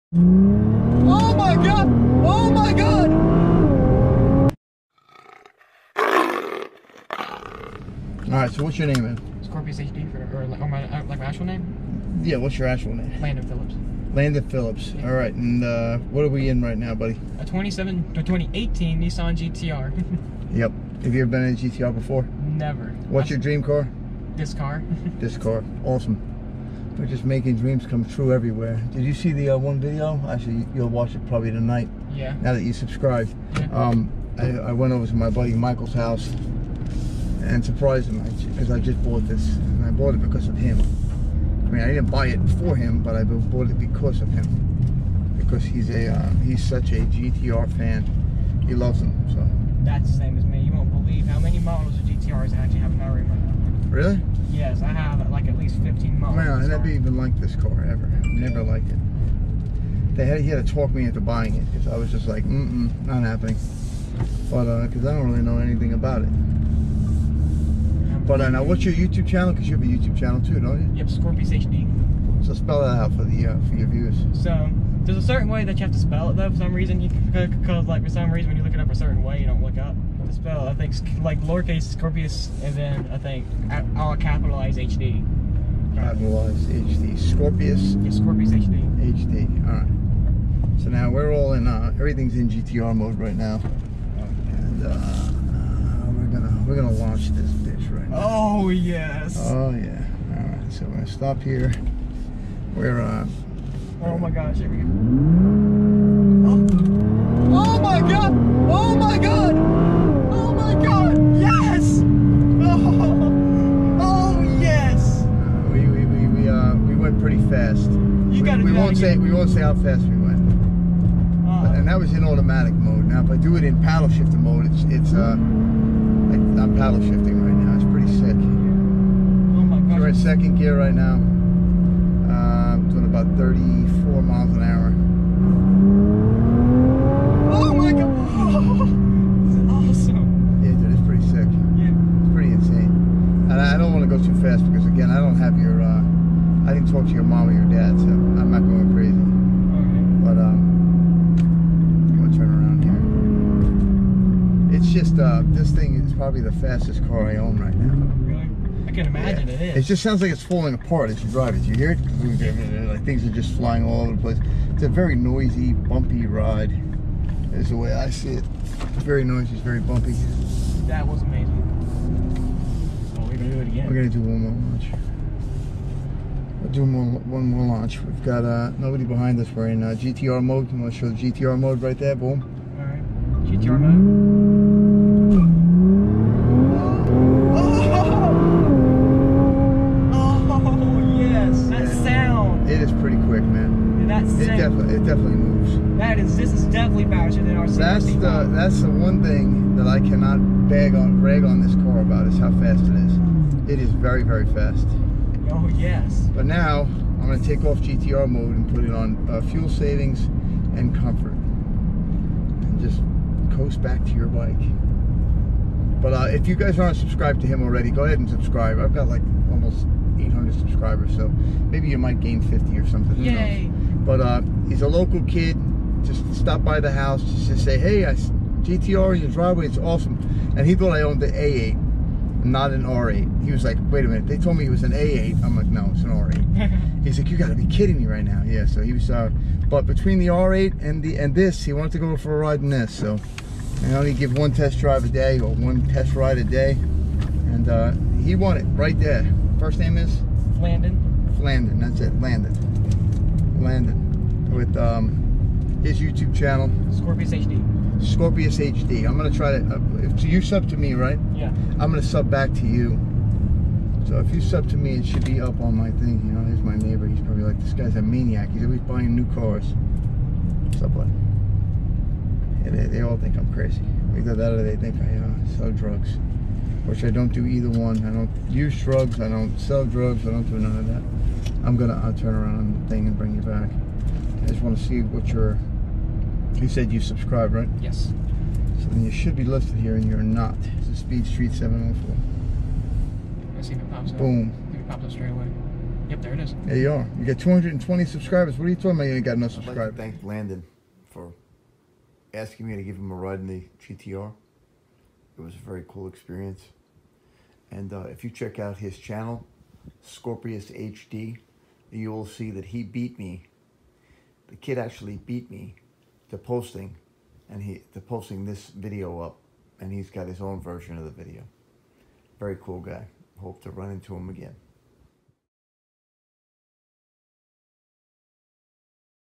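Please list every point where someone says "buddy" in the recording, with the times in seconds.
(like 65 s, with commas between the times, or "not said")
16 s, 35 s.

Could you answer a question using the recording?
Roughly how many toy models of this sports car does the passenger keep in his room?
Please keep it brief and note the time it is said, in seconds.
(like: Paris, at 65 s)
15, at 55 s.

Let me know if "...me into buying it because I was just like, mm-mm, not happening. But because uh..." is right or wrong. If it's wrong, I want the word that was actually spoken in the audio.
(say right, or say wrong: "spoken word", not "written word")
right.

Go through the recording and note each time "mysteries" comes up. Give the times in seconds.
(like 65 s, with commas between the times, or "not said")
not said.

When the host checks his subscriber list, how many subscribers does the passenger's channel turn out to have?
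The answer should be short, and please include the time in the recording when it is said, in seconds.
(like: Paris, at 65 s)
220, at 297 s.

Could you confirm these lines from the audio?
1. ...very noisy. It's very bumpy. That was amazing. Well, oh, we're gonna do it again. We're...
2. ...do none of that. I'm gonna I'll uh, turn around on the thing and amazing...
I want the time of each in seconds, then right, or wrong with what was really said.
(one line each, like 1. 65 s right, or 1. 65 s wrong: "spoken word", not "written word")
1. 169 s right
2. 280 s wrong: "bring", not "amazing".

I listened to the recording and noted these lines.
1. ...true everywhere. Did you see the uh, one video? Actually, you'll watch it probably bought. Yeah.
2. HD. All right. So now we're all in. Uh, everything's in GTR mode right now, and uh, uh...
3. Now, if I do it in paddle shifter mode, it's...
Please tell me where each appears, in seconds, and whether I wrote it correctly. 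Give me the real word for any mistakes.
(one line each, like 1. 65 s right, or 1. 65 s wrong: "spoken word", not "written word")
1. 28 s wrong: "tonight", not "bought"
2. 89 s right
3. 123 s right.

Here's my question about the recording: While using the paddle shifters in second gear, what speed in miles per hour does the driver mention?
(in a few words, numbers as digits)
34.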